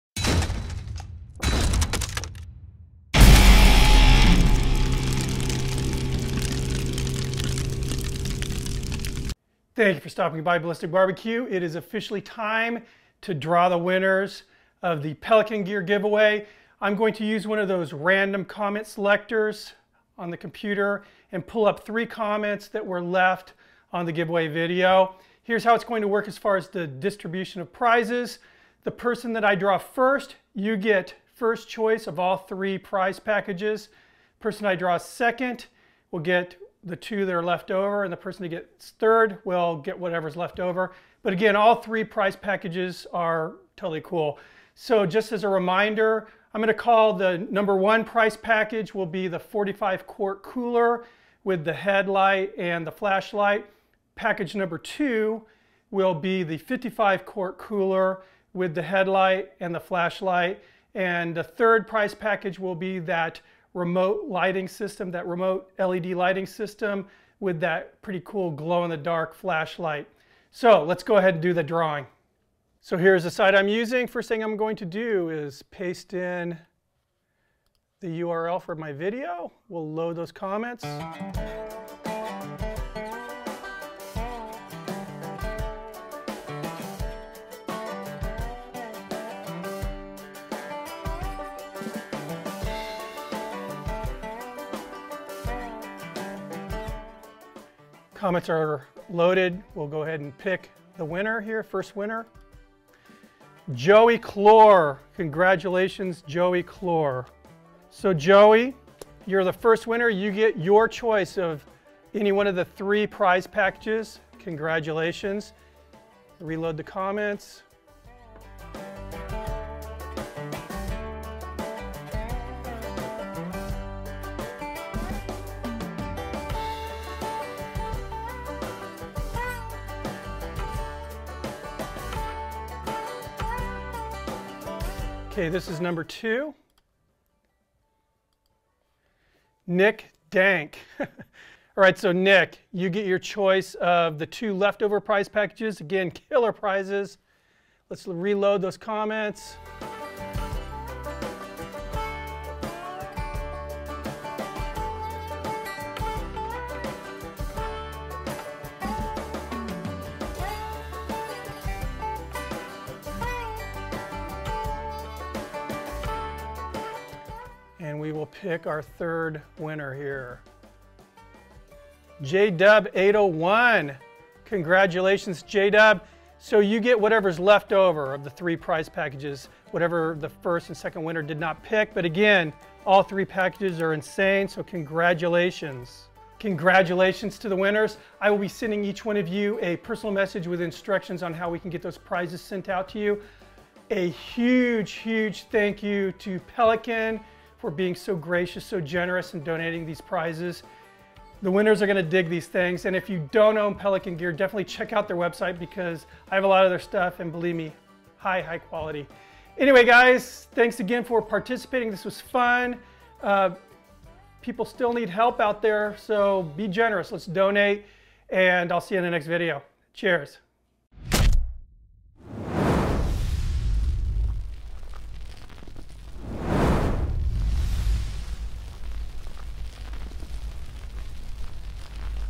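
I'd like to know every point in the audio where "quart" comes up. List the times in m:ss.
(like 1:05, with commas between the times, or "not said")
0:50, 0:57.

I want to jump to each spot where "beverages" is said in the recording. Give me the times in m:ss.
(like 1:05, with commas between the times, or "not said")
not said.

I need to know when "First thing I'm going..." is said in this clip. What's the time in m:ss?
1:14.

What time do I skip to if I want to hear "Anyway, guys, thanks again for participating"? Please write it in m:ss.
3:29.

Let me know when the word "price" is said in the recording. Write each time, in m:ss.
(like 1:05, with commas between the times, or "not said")
0:48, 1:01.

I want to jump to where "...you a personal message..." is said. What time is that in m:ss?
3:09.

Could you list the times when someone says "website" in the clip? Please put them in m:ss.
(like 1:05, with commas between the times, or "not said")
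3:25.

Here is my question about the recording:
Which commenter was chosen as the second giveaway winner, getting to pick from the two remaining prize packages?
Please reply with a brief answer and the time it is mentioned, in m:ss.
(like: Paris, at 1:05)
Nick Dank, at 2:19.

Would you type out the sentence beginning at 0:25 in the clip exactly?
Here's how it's going to work as far as the distribution of prizes.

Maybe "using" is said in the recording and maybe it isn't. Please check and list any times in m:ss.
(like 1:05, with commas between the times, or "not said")
1:13.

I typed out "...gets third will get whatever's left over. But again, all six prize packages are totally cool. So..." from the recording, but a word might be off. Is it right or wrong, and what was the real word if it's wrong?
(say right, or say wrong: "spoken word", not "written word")
wrong: "three", not "six".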